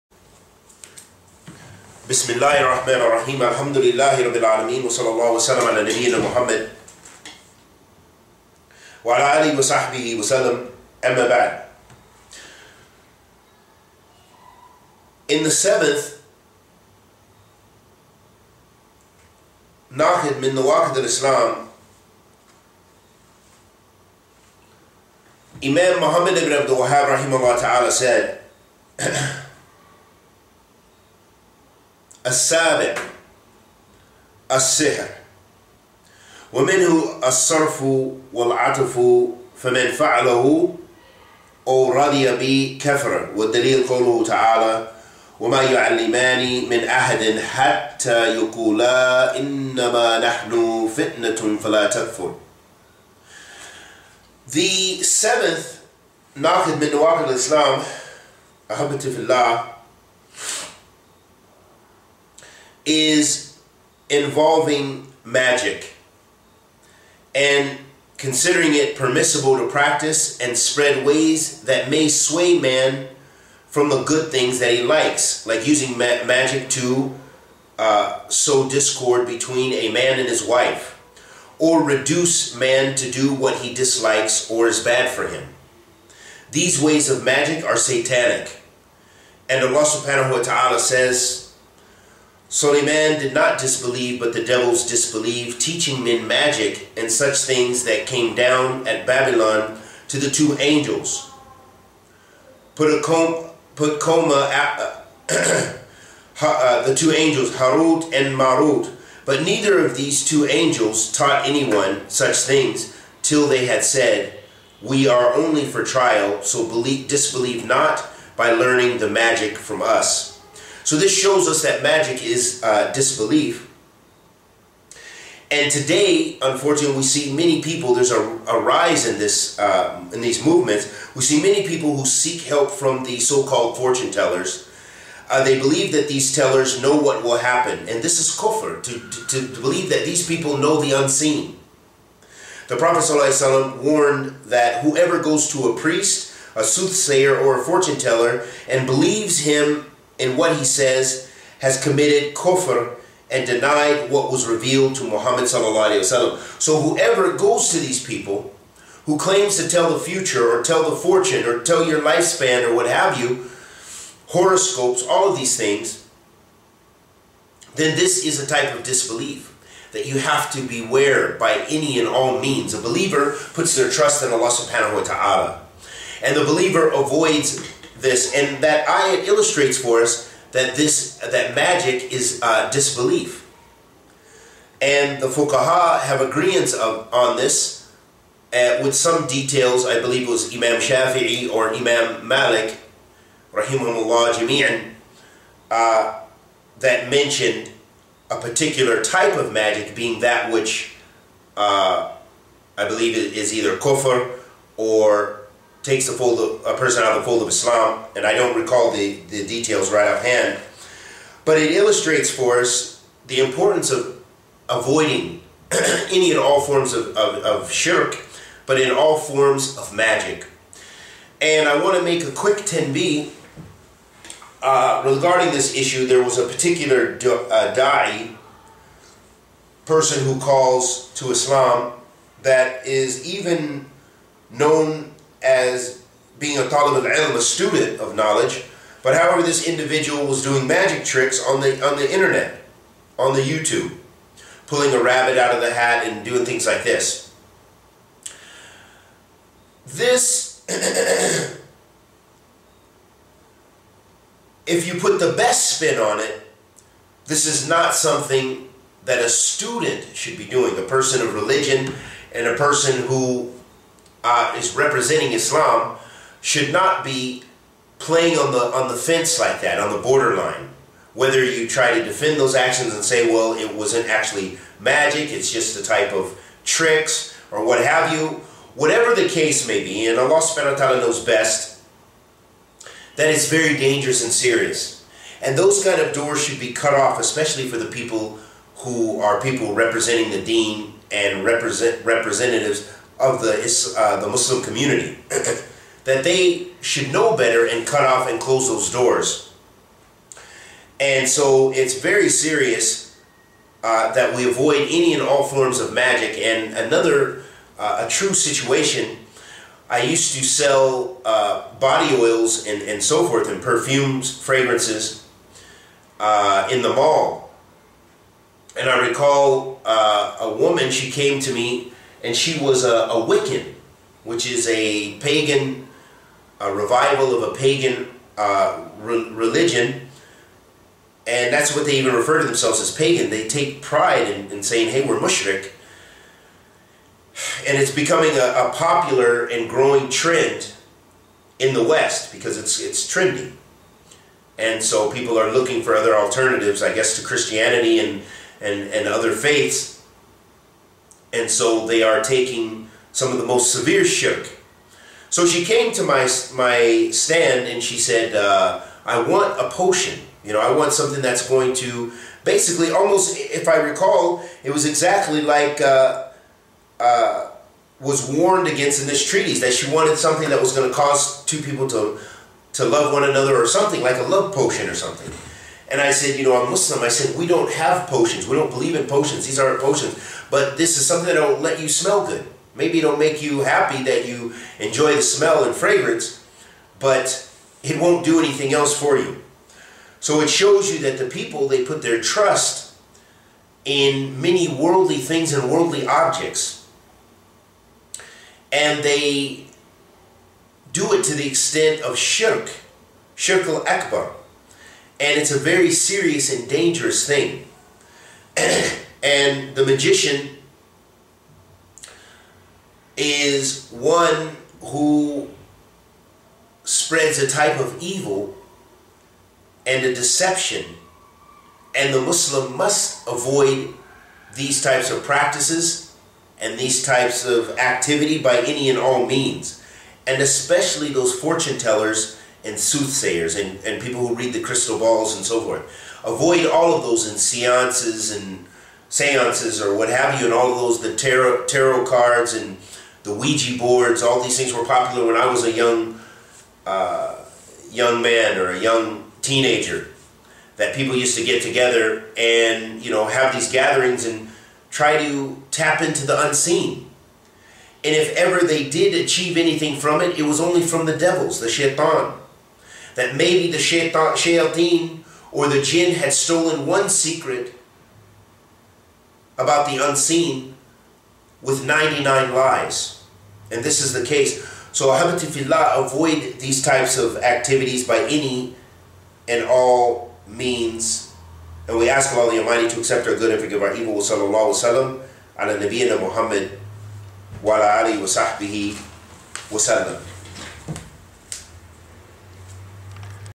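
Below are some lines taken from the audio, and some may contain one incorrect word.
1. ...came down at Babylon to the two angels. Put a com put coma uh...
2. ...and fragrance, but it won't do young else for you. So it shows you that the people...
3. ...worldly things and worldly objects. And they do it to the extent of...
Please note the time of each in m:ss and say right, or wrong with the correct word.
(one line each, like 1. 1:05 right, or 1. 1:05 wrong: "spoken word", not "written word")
1. 1:38 right
2. 6:25 wrong: "anything", not "young"
3. 6:34 right.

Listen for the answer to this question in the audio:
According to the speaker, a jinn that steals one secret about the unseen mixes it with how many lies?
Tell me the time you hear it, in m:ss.
7:51.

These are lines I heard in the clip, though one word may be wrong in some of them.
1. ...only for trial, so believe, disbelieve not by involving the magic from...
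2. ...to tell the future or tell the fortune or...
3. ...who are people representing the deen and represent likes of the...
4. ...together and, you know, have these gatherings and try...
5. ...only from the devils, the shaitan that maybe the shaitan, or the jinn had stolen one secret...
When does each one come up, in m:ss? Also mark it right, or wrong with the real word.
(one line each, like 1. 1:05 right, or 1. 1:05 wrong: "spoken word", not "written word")
1. 1:55 wrong: "learning", not "involving"
2. 2:39 right
3. 4:48 wrong: "representatives", not "likes"
4. 7:31 right
5. 7:40 right.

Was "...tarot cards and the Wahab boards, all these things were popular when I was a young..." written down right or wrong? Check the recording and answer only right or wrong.
wrong.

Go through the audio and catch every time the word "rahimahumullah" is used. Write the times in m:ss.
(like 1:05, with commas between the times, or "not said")
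3:13.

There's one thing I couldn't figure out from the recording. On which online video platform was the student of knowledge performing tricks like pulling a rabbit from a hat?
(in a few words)
YouTube.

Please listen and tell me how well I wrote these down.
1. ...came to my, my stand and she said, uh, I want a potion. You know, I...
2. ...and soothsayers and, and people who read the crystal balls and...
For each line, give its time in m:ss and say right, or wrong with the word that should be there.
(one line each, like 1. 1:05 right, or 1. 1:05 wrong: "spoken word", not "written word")
1. 5:55 right
2. 7:12 right.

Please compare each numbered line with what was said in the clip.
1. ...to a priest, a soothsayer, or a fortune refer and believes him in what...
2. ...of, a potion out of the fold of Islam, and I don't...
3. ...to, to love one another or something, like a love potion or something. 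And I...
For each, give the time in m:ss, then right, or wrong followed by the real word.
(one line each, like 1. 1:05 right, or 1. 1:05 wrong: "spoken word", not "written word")
1. 2:25 wrong: "teller", not "refer"
2. 3:26 wrong: "person", not "potion"
3. 6:11 right.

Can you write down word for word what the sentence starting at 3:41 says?
And I want to make a quick 10b uh, regarding this issue.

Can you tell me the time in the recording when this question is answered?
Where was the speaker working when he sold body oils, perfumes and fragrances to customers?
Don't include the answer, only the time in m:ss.
5:16.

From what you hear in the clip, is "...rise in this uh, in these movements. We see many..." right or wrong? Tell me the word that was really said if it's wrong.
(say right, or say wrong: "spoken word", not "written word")
right.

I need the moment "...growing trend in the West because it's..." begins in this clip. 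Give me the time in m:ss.
5:39.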